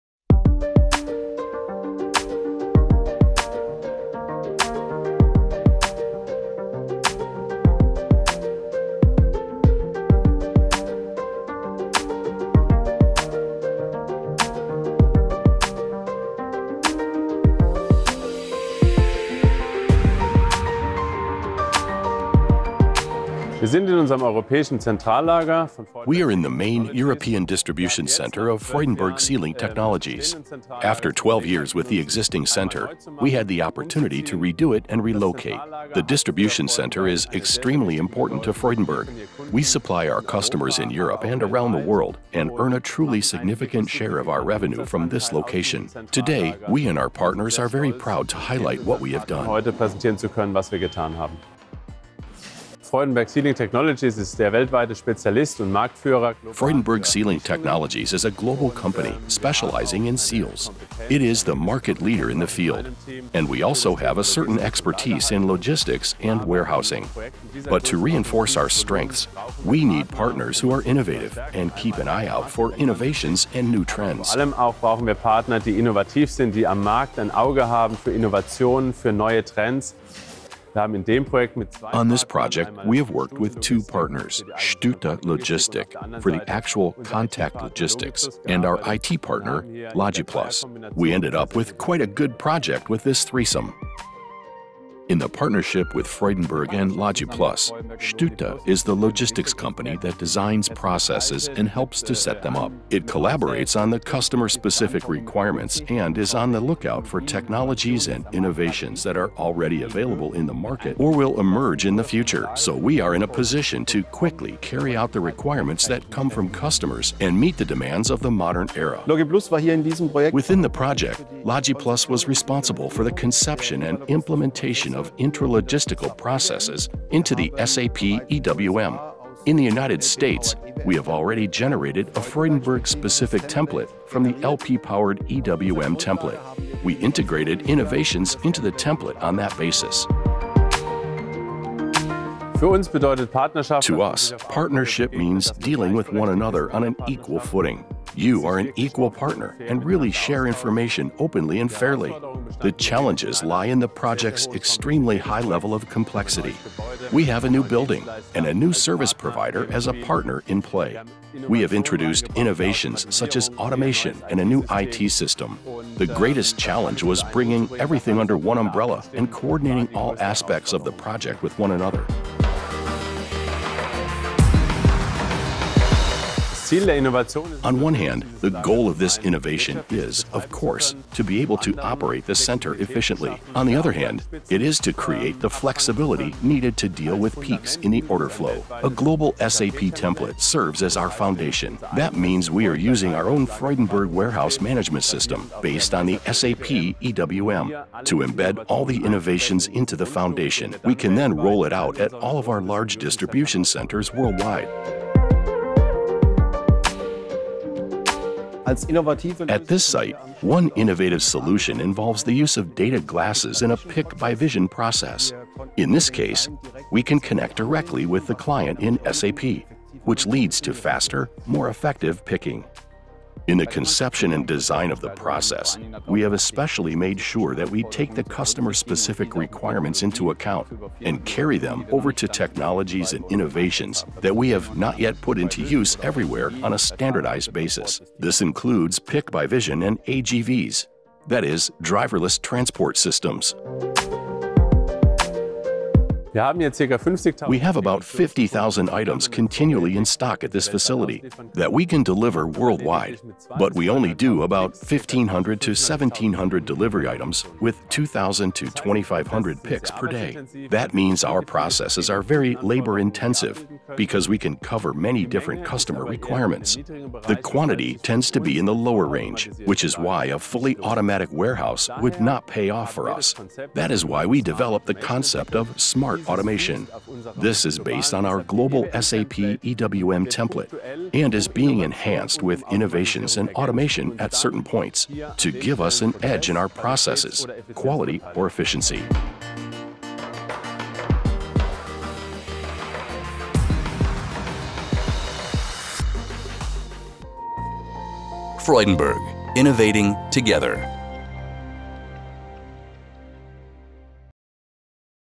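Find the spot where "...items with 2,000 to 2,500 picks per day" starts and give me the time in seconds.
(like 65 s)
257 s.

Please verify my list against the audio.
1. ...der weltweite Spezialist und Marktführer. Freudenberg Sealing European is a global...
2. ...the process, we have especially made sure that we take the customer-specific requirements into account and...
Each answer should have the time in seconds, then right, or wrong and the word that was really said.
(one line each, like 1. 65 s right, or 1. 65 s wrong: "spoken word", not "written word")
1. 54 s wrong: "Technologies", not "European"
2. 225 s right.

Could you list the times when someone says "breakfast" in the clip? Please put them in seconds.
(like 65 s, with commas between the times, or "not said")
not said.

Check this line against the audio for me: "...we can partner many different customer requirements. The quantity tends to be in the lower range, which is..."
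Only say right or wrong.
wrong.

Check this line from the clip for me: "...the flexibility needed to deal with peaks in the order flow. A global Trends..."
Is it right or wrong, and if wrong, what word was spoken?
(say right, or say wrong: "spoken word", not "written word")
wrong: "SAP", not "Trends".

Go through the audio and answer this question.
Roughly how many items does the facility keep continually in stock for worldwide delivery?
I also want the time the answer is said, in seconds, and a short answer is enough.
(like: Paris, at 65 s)
50,000, at 248 s.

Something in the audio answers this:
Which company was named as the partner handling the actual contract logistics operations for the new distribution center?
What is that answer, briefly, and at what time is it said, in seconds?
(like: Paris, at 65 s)
Stute Logistic, at 84 s.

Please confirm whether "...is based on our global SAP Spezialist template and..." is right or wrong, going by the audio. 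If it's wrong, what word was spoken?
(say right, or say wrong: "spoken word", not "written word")
wrong: "EWM", not "Spezialist".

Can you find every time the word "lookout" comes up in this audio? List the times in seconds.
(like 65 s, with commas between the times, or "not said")
106 s.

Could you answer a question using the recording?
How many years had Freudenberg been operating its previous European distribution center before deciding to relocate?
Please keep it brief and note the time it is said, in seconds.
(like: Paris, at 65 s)
12, at 31 s.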